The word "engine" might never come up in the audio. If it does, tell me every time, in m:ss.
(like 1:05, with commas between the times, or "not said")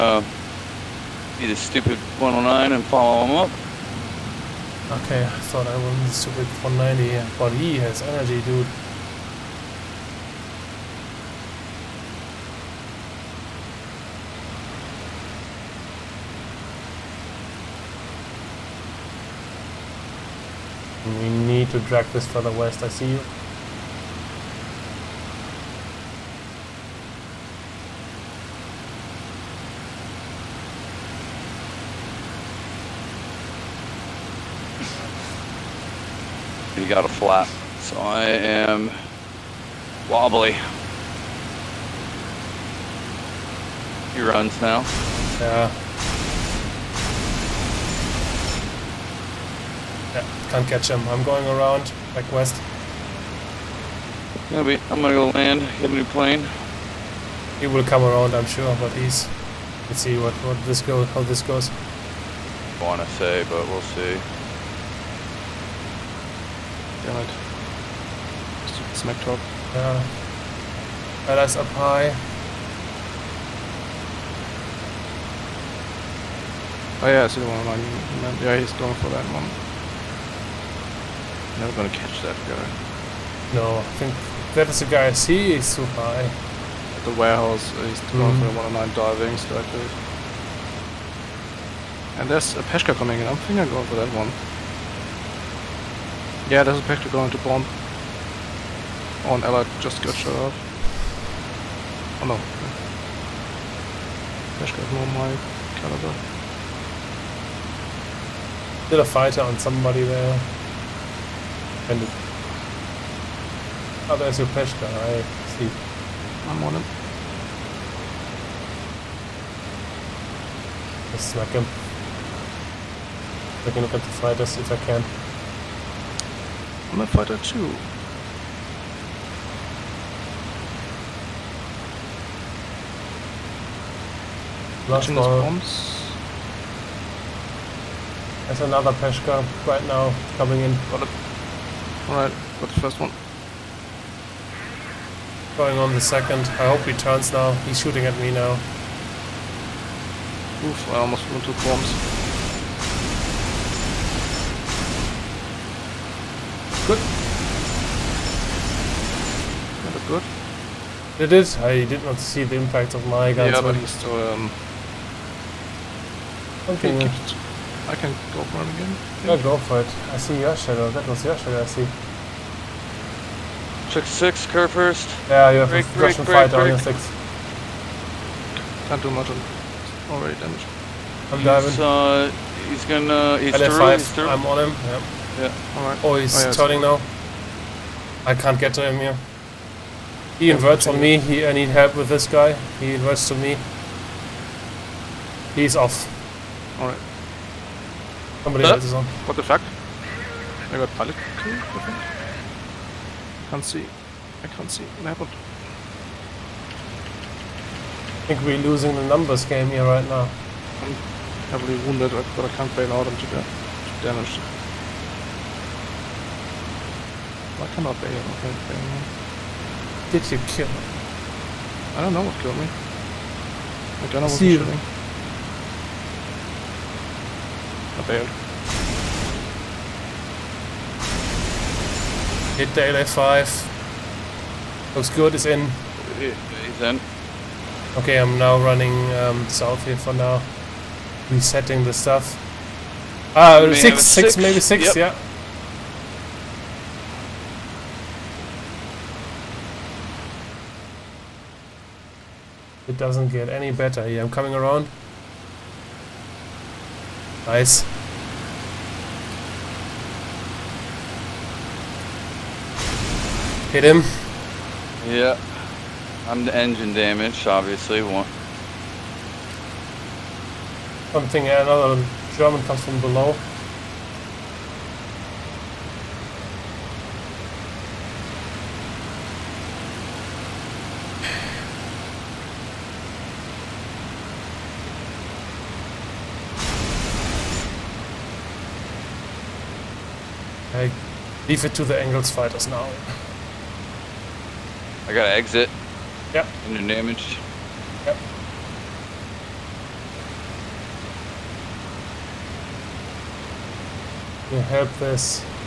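4:26, 4:56.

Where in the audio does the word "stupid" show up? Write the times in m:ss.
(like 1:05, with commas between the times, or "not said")
0:01, 0:06.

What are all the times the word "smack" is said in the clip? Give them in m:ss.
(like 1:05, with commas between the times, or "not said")
1:08, 2:01.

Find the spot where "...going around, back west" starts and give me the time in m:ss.
0:51.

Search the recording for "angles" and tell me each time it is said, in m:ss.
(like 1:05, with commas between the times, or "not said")
4:51.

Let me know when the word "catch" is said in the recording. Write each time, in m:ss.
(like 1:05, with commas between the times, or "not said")
0:50, 1:21.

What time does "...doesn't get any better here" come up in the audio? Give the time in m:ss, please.
4:12.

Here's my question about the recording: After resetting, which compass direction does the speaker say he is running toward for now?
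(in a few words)
South.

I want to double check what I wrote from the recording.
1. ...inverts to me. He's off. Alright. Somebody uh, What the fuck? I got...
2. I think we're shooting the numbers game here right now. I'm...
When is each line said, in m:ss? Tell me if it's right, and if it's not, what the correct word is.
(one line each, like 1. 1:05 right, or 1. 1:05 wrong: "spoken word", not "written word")
1. 3:12 right
2. 3:28 wrong: "losing", not "shooting".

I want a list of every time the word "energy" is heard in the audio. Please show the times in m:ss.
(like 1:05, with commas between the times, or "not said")
0:08.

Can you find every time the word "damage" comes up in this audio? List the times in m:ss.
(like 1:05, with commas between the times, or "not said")
3:00, 3:34, 4:26, 4:56.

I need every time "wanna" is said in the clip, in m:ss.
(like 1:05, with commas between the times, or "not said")
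1:02.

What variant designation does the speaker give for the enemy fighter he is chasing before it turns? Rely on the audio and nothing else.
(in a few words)
LF5.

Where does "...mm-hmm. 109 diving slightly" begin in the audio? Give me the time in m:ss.
1:28.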